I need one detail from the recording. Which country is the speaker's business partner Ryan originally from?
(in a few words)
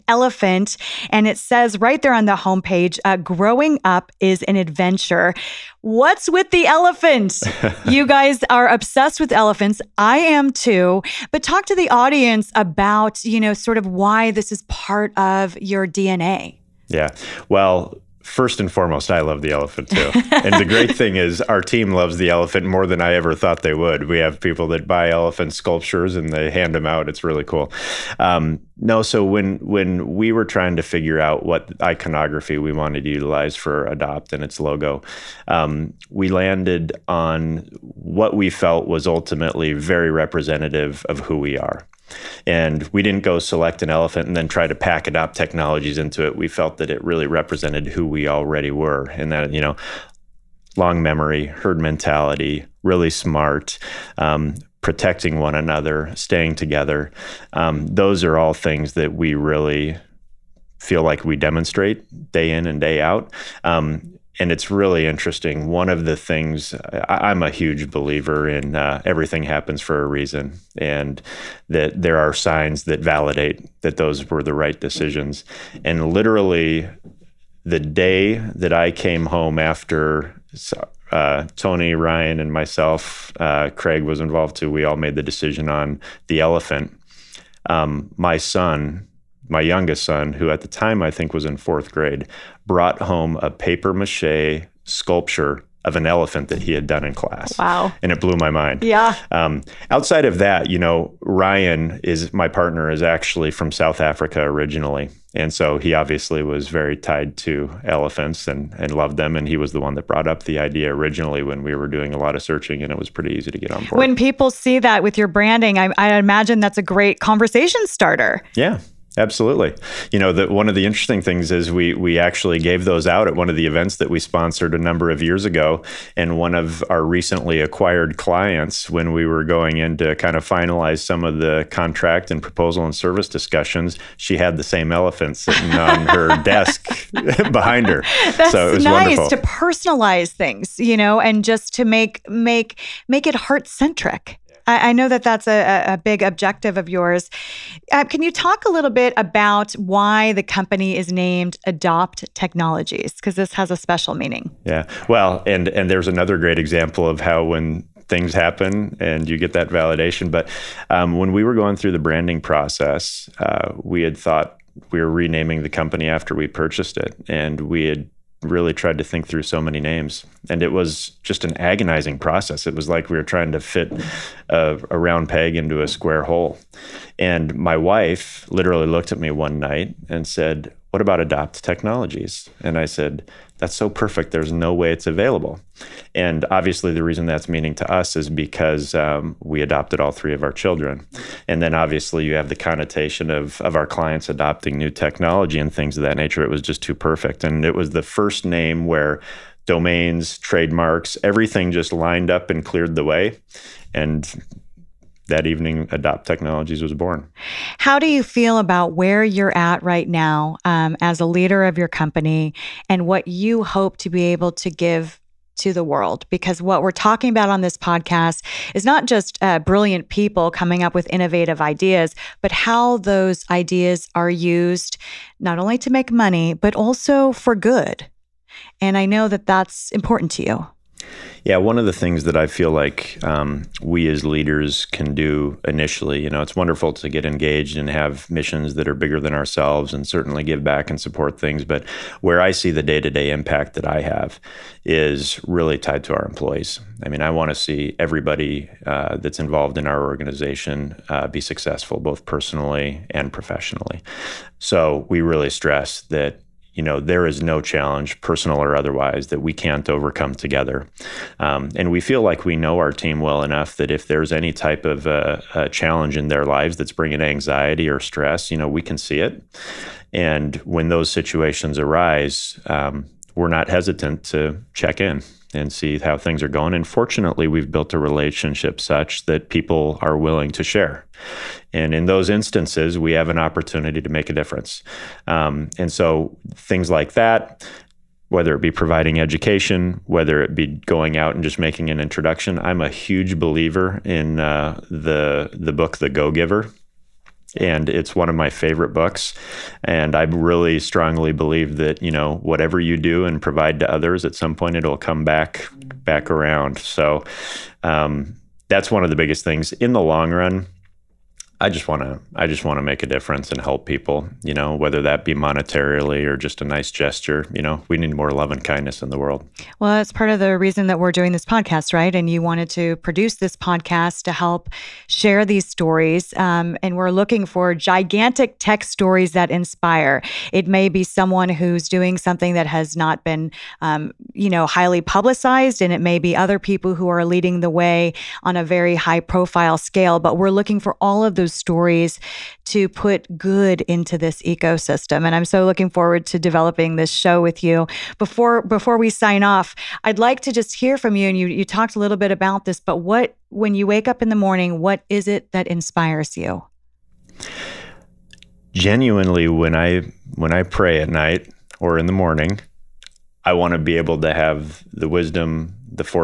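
South Africa.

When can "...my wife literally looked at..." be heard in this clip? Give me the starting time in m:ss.
2:57.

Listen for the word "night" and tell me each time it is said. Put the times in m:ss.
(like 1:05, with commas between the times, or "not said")
2:59, 6:01.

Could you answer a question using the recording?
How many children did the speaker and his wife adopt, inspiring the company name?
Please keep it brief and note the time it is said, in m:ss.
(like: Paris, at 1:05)
3, at 3:10.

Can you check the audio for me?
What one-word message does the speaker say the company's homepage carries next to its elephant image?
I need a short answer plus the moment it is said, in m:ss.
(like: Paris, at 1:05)
Grow, at 0:03.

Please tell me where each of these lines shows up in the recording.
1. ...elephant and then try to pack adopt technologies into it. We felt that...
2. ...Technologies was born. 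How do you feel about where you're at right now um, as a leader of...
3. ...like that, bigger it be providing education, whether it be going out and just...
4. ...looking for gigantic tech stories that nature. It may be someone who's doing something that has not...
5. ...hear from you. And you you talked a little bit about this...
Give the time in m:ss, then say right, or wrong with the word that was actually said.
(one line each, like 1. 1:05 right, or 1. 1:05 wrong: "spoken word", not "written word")
1. 0:43 right
2. 3:26 right
3. 4:46 wrong: "whether", not "bigger"
4. 5:27 wrong: "inspire", not "nature"
5. 5:50 right.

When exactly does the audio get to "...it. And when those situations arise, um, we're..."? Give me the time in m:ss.
4:29.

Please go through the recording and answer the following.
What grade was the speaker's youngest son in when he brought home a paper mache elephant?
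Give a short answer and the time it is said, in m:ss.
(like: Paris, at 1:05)
Fourth grade, at 1:31.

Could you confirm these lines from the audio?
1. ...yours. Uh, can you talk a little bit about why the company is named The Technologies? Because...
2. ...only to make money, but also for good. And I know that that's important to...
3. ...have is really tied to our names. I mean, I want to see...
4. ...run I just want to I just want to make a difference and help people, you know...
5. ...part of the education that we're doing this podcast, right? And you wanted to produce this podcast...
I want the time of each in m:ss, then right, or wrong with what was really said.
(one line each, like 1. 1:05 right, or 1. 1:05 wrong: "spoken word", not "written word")
1. 2:26 wrong: "Adopt", not "The"
2. 3:45 right
3. 4:03 wrong: "employees", not "names"
4. 5:10 right
5. 5:20 wrong: "reason", not "education".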